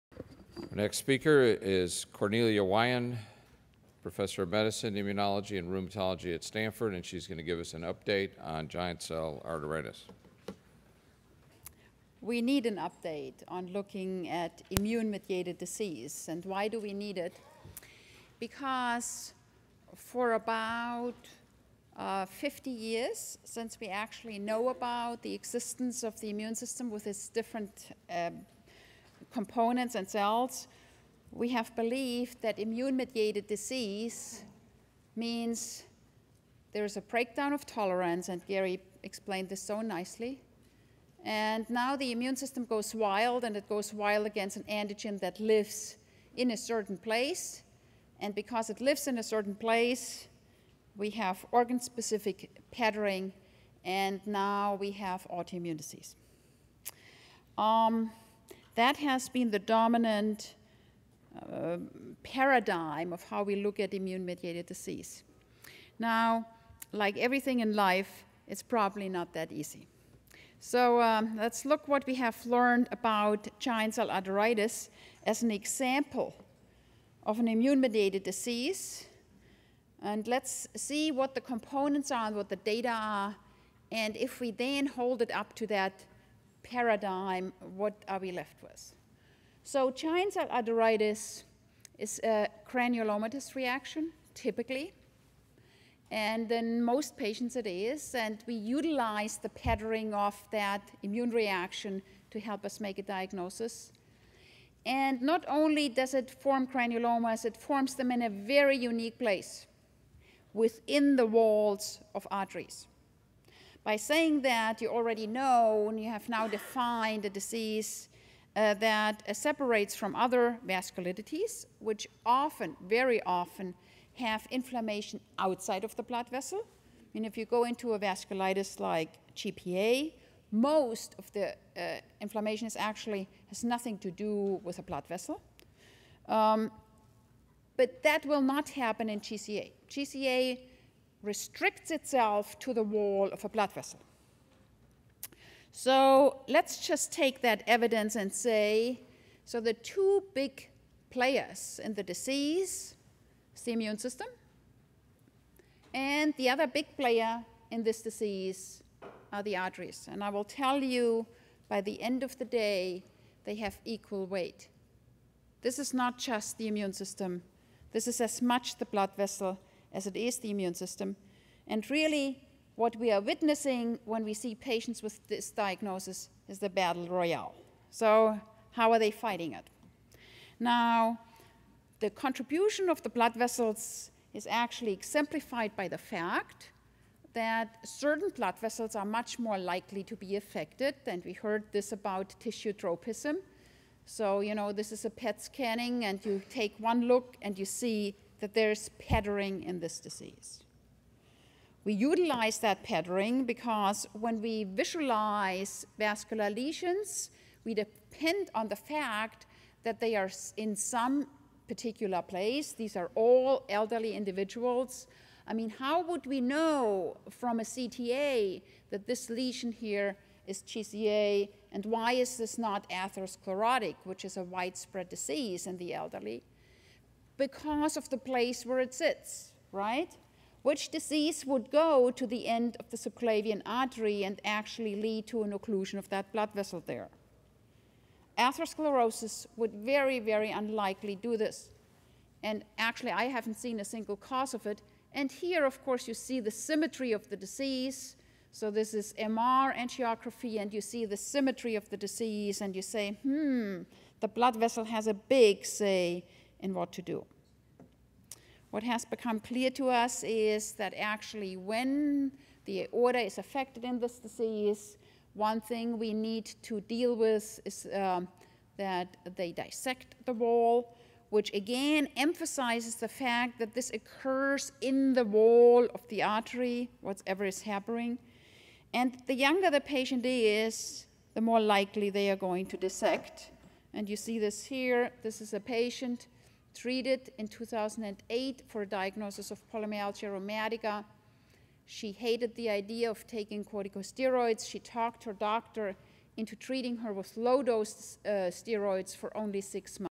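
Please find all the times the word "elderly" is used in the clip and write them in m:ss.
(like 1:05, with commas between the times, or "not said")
3:33, 3:45.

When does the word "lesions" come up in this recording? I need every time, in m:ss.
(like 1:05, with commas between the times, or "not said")
3:26, 3:39.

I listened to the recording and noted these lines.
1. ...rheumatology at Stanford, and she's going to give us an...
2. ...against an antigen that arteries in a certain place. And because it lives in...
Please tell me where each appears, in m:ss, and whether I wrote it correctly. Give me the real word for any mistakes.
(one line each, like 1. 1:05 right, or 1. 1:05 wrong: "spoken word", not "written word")
1. 0:05 right
2. 0:44 wrong: "lives", not "arteries".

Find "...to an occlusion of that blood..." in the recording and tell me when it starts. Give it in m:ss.
3:55.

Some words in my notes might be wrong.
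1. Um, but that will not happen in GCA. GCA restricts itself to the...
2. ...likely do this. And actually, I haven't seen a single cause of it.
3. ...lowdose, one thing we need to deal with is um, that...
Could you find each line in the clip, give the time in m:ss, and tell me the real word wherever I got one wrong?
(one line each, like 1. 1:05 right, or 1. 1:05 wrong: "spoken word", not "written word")
1. 2:16 right
2. 4:00 wrong: "unlikely", not "likely"
3. 4:24 wrong: "disease", not "lowdose".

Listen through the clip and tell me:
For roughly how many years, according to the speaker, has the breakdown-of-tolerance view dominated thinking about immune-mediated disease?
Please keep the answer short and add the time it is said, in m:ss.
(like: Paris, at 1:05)
50 years, at 0:22.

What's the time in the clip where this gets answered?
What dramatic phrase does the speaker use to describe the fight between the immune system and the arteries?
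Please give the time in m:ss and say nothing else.
2:56.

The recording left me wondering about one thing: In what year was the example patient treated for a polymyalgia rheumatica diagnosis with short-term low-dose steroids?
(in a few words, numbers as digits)
2008.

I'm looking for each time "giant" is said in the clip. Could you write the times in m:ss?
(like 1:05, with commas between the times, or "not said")
0:08, 1:13, 1:29.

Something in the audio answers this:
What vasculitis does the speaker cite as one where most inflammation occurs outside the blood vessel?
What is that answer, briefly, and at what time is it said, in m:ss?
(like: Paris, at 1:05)
GPA, at 2:09.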